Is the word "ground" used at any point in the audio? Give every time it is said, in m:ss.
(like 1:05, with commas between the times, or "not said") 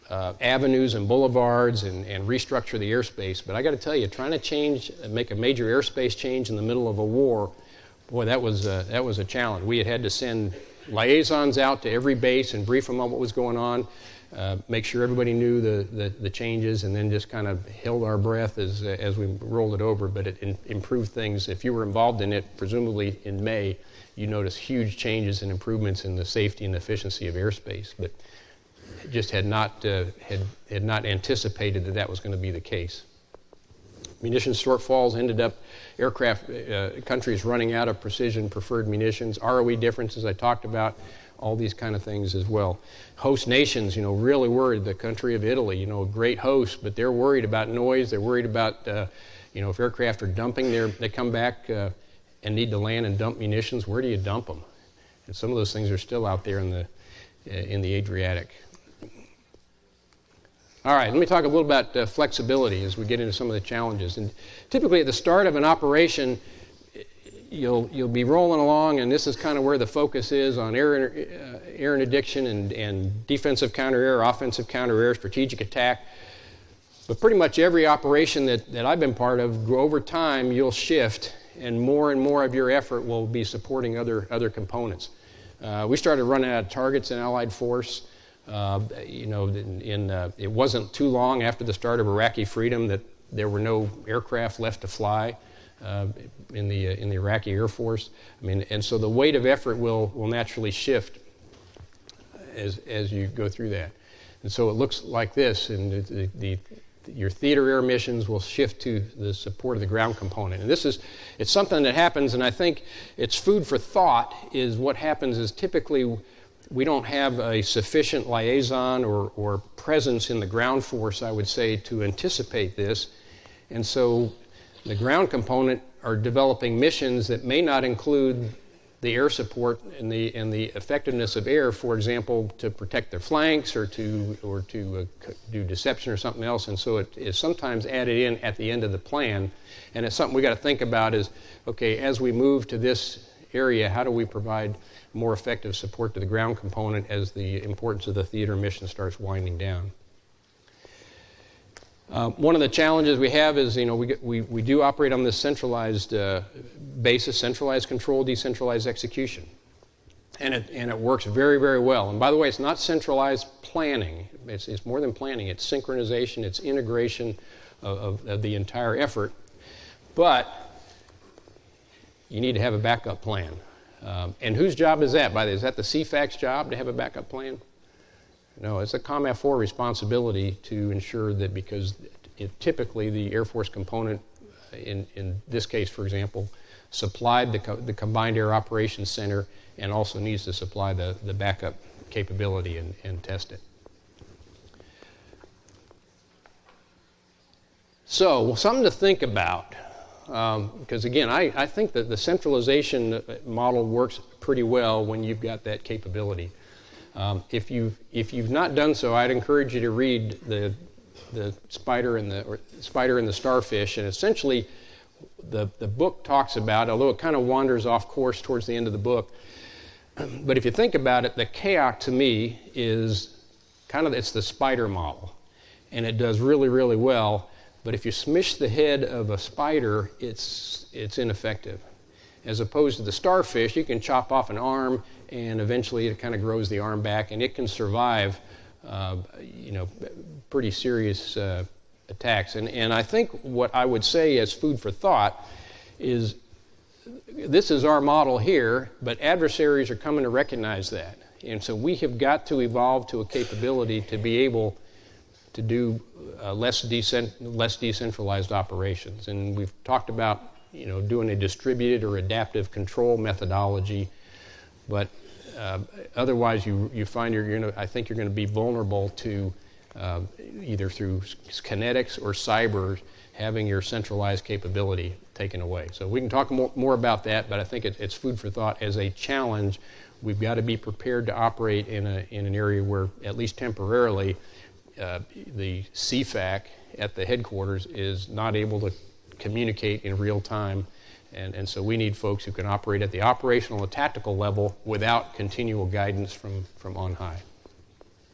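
1:49, 2:00, 2:04, 2:26.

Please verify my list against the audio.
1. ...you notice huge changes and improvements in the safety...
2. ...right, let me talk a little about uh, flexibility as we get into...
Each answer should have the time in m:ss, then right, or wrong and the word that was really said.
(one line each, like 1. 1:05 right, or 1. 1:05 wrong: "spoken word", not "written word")
1. 0:24 right
2. 1:00 right.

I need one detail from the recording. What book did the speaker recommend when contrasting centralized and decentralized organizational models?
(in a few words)
The Spider and the Starfish.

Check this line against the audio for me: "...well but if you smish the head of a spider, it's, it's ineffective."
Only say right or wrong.
right.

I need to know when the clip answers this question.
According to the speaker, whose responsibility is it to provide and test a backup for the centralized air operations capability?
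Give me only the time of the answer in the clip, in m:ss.
2:58.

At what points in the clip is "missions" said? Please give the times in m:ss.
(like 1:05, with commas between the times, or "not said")
1:47, 2:06, 2:28.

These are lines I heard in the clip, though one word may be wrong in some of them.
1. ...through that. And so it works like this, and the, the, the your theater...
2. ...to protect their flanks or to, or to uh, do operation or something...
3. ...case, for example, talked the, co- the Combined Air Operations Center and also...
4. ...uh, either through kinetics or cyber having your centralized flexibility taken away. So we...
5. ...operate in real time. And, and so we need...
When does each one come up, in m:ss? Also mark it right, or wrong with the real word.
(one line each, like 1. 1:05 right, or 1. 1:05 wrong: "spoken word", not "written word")
1. 1:43 wrong: "looks", not "works"
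2. 2:12 wrong: "deception", not "operation"
3. 3:05 wrong: "supplied", not "talked"
4. 4:29 wrong: "capability", not "flexibility"
5. 4:49 wrong: "communicate", not "operate".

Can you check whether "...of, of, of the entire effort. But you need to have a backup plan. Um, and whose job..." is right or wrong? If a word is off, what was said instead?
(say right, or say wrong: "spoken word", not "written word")
right.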